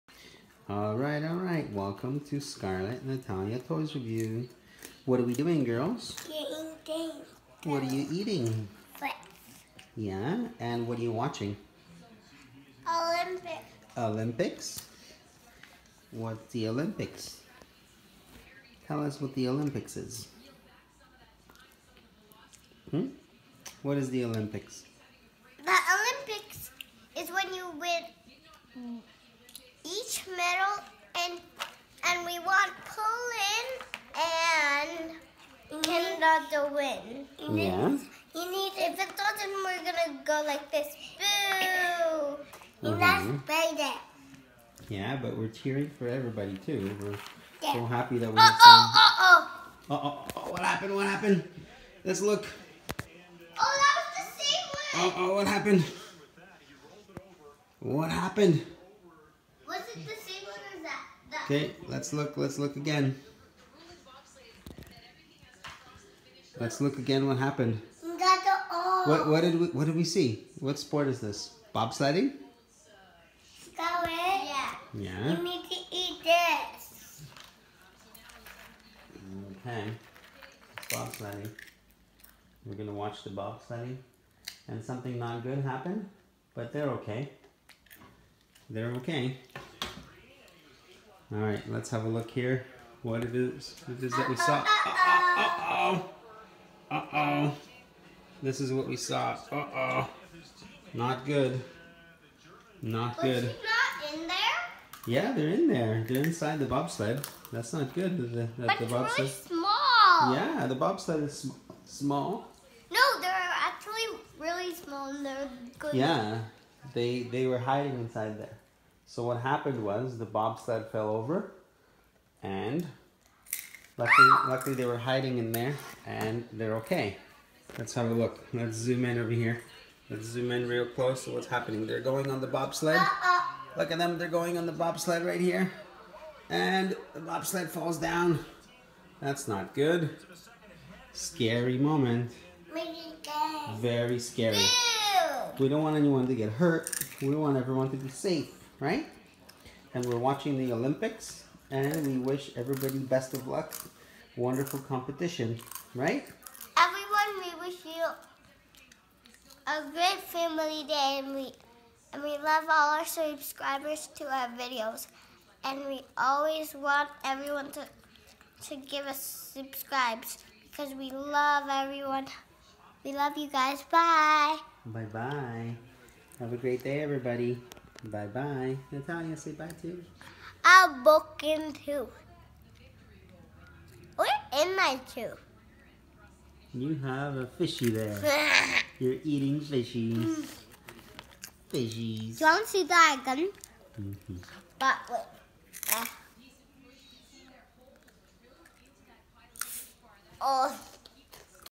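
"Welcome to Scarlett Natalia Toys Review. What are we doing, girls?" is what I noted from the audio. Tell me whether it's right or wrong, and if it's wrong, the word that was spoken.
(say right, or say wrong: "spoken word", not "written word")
right.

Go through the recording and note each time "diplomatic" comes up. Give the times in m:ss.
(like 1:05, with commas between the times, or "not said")
not said.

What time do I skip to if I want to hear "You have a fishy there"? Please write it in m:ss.
3:06.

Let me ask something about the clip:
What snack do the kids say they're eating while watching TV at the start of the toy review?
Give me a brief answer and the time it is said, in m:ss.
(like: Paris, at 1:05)
Flips, at 0:08.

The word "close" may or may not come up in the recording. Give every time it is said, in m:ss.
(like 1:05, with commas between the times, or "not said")
2:10.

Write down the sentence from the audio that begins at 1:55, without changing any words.
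Yeah, they they were hiding inside there.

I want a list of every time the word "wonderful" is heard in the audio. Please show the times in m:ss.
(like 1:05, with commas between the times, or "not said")
2:34.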